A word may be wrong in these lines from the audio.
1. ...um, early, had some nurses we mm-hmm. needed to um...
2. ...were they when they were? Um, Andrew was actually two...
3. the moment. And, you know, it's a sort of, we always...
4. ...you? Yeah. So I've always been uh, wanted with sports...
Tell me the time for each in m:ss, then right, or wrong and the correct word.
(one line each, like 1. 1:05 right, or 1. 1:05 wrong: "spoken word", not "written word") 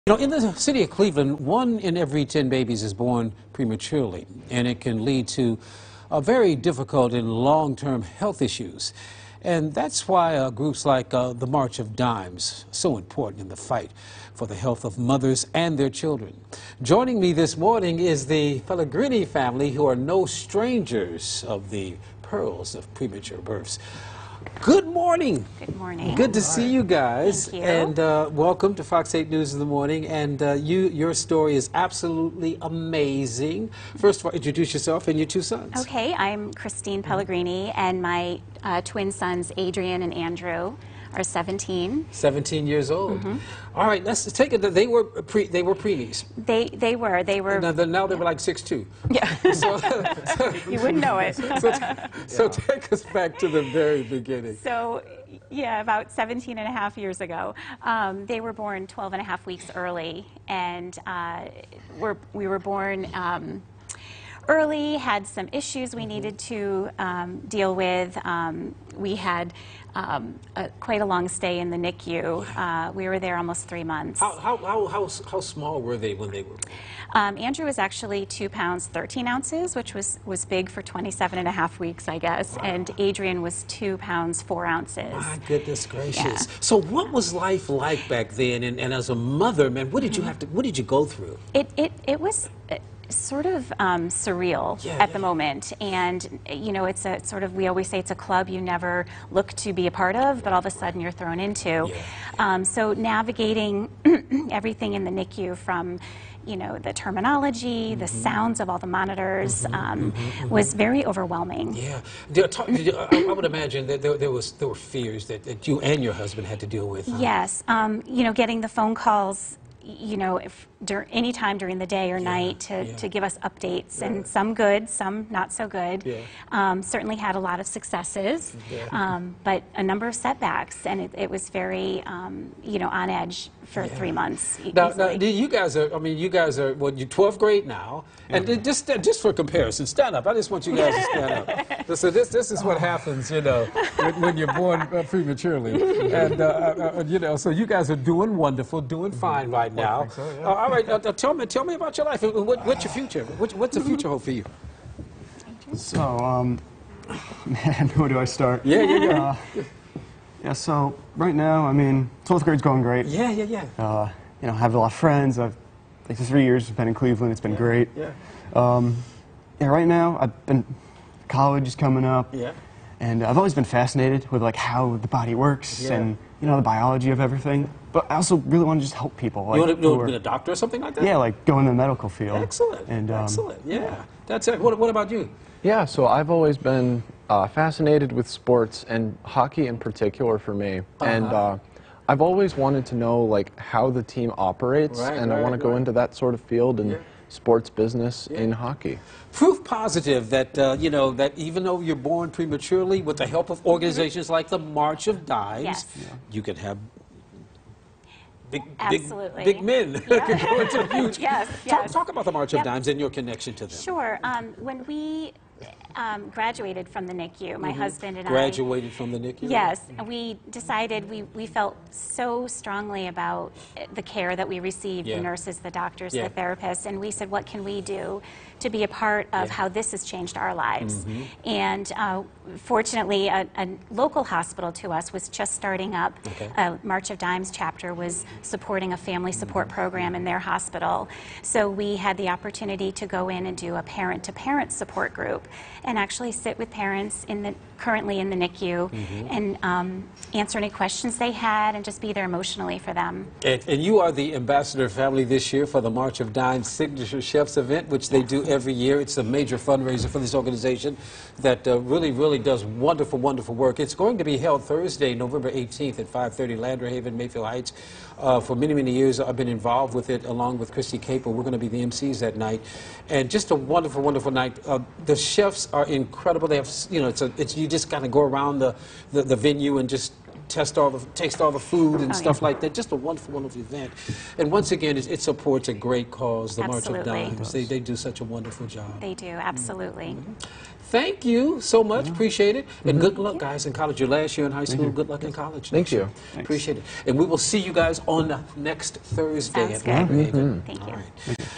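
1. 1:03 wrong: "issues", not "nurses"
2. 1:15 right
3. 1:35 right
4. 3:05 wrong: "fascinated", not "wanted".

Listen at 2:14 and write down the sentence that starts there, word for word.
now, now, you guys are, I mean, you guys are, well, you're 12th grade now, and just, just for comparison, stand up.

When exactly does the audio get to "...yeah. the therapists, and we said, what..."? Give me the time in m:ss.
3:46.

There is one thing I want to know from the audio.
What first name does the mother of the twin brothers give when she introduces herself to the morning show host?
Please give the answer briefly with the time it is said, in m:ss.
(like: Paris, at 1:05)
Christine, at 0:36.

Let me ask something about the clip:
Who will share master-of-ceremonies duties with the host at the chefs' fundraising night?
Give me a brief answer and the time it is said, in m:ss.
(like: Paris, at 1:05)
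Kristi Capel, at 4:30.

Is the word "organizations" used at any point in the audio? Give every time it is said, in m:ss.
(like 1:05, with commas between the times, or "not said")
3:23, 4:20.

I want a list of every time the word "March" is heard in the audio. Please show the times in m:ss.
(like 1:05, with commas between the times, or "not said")
0:11, 3:24, 3:32, 3:56, 4:15, 4:47.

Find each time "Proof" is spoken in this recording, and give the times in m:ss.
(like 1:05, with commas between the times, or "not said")
3:19.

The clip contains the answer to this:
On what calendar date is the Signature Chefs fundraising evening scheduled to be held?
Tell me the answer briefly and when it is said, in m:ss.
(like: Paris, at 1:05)
Thursday, November 18, at 4:25.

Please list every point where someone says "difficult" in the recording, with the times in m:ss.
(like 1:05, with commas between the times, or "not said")
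0:06.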